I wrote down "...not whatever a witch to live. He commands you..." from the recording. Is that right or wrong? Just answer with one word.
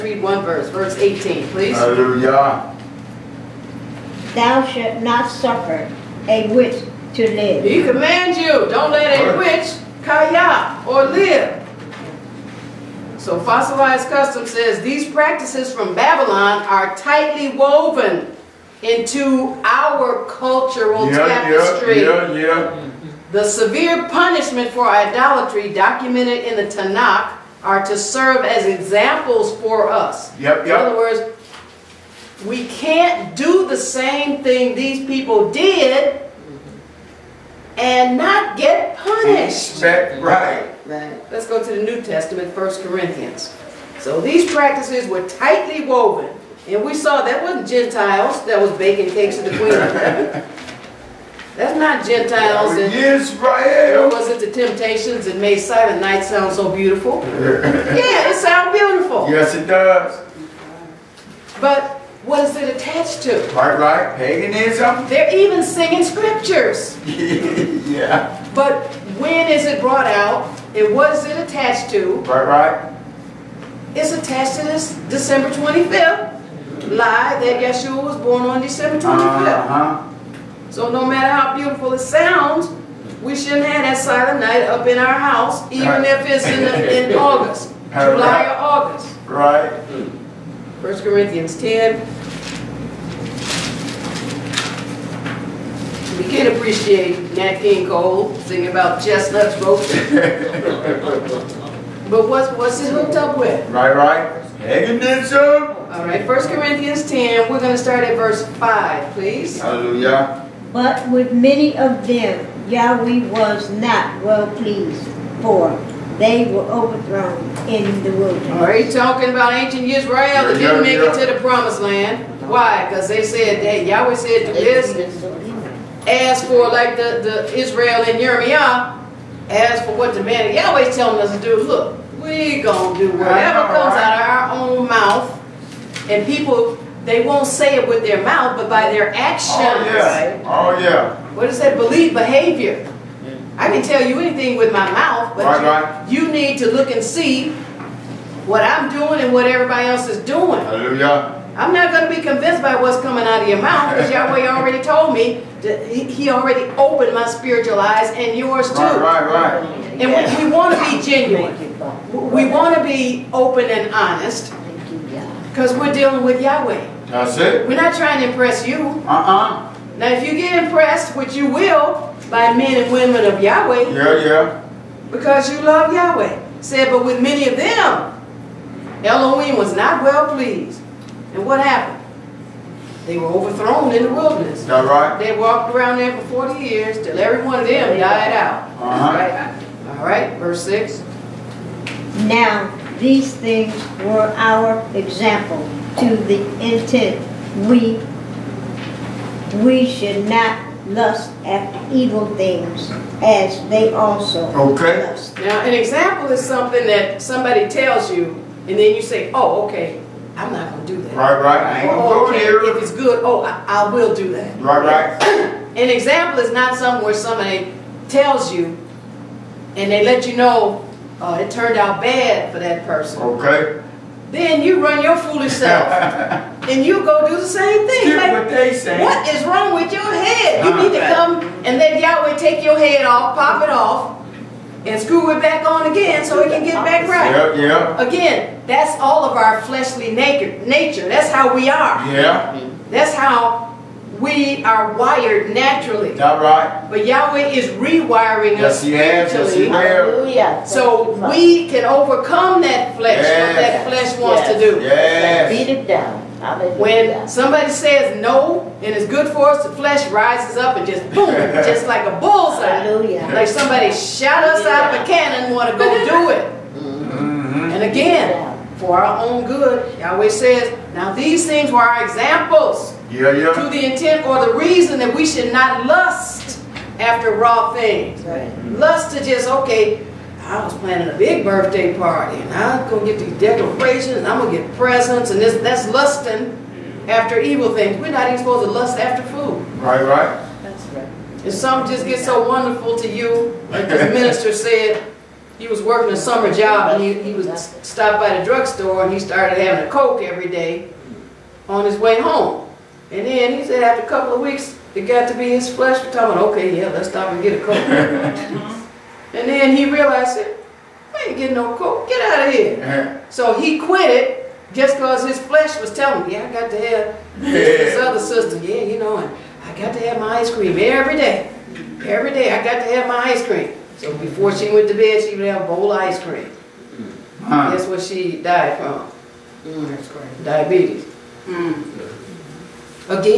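wrong.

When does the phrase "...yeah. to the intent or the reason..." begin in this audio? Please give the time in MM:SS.
04:33.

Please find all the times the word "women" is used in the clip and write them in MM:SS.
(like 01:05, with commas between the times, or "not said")
02:52.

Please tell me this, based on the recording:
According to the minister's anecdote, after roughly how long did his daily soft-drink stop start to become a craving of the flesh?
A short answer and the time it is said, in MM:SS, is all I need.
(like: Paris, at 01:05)
A couple of weeks, at 05:04.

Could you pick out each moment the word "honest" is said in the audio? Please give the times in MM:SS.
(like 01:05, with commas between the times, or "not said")
02:43.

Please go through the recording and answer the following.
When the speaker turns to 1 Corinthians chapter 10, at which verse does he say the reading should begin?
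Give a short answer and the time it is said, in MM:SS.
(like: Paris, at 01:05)
5, at 01:48.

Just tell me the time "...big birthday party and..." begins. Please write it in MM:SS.
04:41.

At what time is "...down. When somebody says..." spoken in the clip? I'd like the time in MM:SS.
04:15.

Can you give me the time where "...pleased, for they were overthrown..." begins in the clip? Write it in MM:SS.
01:54.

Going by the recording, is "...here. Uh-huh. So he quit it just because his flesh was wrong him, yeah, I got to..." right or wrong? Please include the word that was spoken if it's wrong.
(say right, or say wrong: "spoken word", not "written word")
wrong: "telling", not "wrong".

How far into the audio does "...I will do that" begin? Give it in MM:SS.
03:33.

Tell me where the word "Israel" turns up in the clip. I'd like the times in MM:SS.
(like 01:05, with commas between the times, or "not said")
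00:52, 01:59, 02:07.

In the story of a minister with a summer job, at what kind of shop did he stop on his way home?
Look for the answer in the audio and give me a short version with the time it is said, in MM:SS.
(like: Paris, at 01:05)
Drugstore, at 04:58.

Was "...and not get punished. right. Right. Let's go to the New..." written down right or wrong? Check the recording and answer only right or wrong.
right.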